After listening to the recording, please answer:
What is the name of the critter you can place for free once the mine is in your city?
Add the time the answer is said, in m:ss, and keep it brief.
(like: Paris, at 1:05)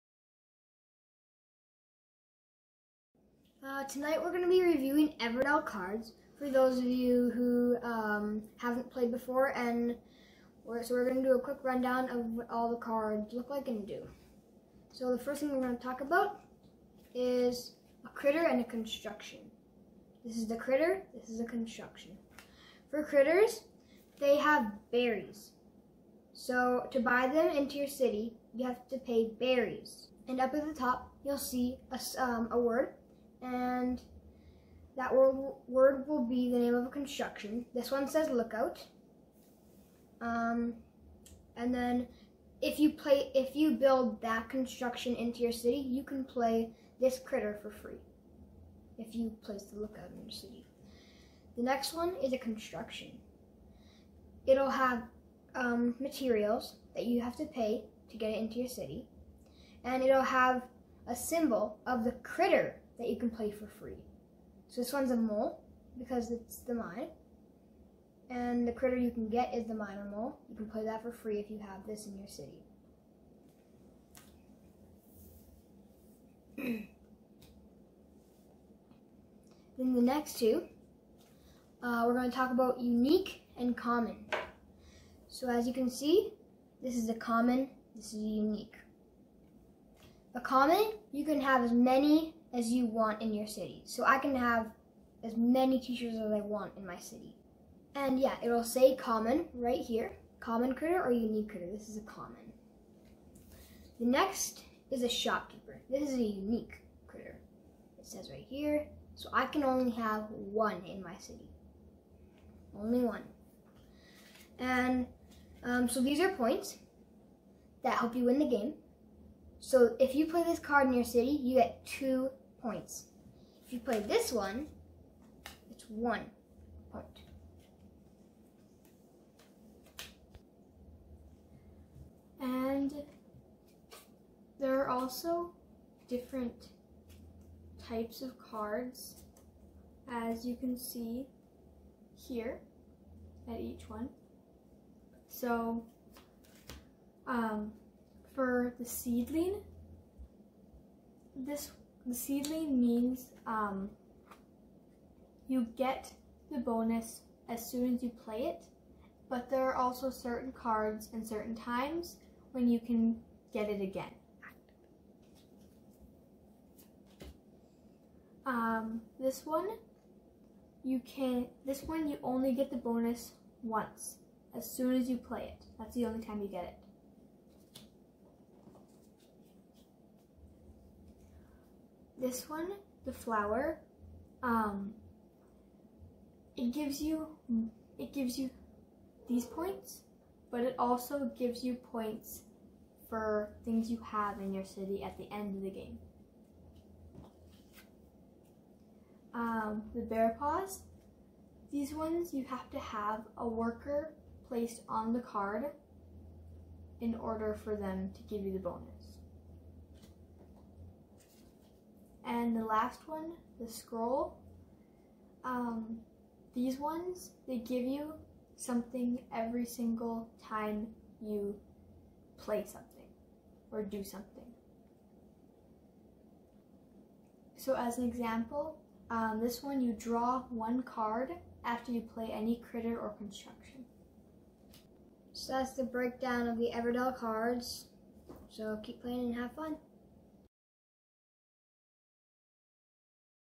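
Minor mole, at 1:09.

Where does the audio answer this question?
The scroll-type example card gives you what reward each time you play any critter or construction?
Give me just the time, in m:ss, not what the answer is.
3:49.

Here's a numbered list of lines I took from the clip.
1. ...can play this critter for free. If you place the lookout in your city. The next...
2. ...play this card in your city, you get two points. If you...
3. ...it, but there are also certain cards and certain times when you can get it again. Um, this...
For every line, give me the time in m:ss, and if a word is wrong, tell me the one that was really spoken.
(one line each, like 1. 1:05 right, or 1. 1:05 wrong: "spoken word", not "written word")
1. 0:46 right
2. 2:00 right
3. 2:38 right.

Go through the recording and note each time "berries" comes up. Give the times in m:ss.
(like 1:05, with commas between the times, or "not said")
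0:24, 0:29.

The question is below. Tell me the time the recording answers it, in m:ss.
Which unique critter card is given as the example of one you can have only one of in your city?
1:45.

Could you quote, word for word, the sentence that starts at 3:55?
So that's the breakdown of the Everdell cards.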